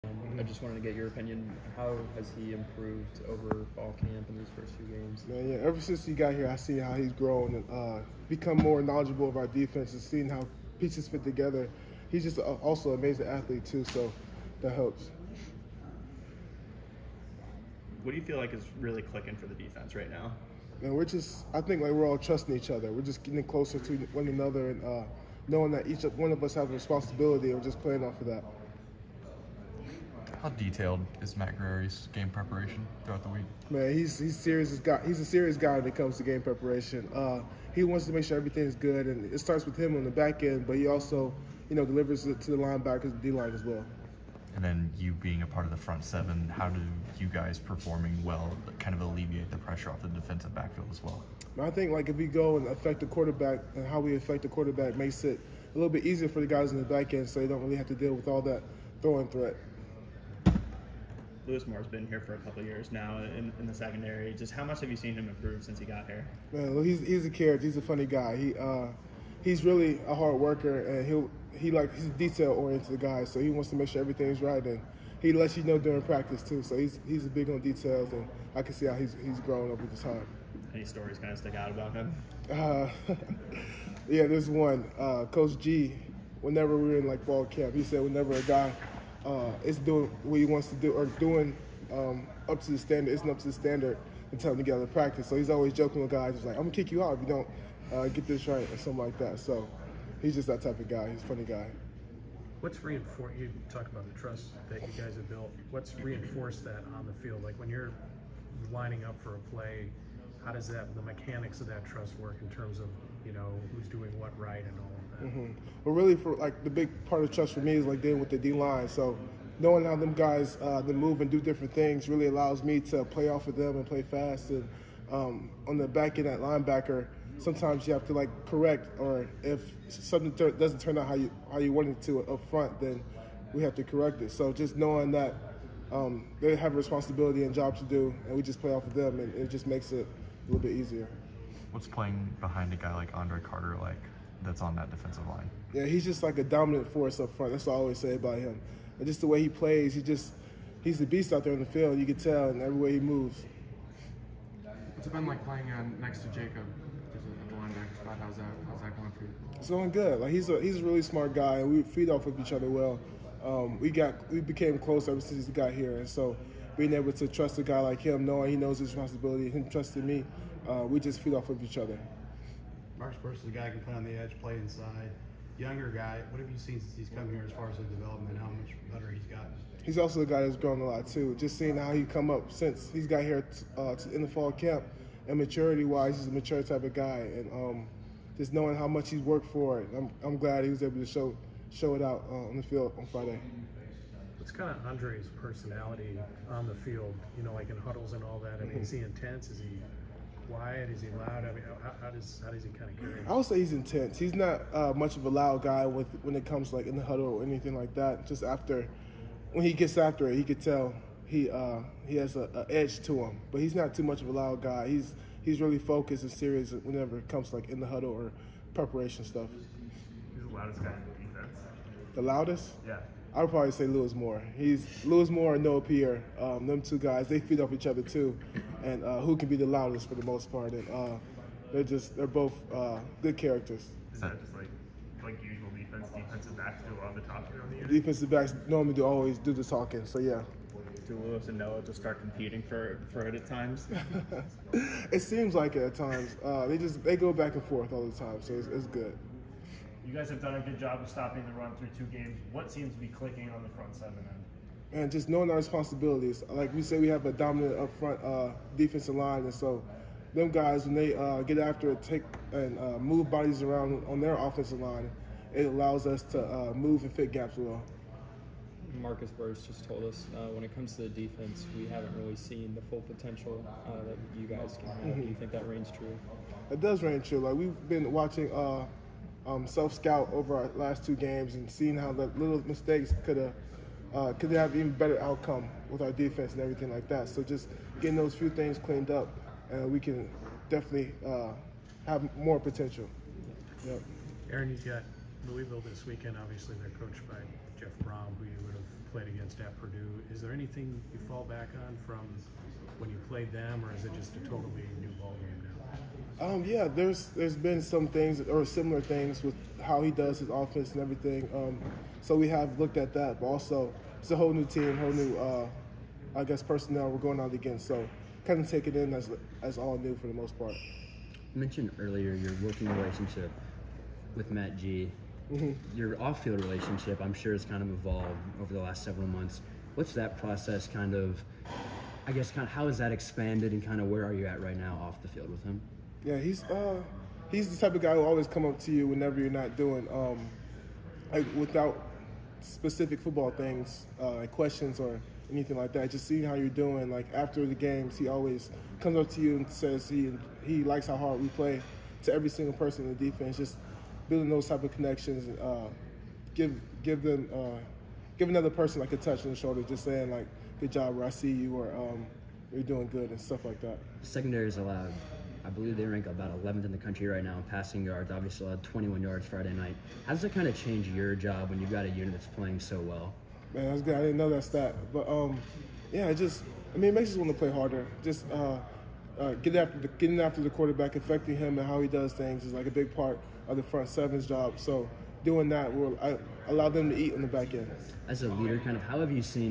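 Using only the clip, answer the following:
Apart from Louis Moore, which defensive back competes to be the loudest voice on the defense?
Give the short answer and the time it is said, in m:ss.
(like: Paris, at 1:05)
Noah Pierre, at 3:45.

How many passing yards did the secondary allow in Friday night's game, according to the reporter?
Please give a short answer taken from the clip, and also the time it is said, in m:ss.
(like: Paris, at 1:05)
21, at 6:08.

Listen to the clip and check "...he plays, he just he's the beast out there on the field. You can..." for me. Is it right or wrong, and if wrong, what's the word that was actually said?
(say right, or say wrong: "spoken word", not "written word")
right.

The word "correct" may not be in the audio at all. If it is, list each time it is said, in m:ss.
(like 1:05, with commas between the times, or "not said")
2:08, 2:13.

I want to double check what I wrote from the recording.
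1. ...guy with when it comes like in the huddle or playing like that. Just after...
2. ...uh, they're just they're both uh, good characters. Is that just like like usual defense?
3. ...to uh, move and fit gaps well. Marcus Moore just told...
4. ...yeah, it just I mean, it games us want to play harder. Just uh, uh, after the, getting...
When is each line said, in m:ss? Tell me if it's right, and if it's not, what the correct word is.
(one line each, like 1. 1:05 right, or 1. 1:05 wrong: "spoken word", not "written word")
1. 3:25 wrong: "anything", not "playing"
2. 3:50 right
3. 4:26 wrong: "Burris", not "Moore"
4. 6:16 wrong: "makes", not "games".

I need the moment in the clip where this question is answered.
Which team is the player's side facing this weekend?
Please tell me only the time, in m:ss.
4:55.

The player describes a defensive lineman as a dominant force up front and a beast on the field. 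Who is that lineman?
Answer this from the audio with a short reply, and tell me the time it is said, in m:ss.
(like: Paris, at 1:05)
Andre Carter, at 2:23.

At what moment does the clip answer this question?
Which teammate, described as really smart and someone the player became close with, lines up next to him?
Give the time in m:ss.
2:36.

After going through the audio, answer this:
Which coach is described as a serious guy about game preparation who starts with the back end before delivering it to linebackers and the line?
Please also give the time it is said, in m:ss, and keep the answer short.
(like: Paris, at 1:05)
Matt Guerrieri, at 0:31.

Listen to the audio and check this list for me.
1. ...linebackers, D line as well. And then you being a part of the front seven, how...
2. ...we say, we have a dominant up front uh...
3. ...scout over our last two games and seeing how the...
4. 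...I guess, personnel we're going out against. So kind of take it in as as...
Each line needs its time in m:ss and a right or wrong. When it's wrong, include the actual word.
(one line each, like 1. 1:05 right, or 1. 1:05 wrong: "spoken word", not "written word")
1. 0:42 right
2. 4:16 right
3. 4:39 right
4. 5:16 right.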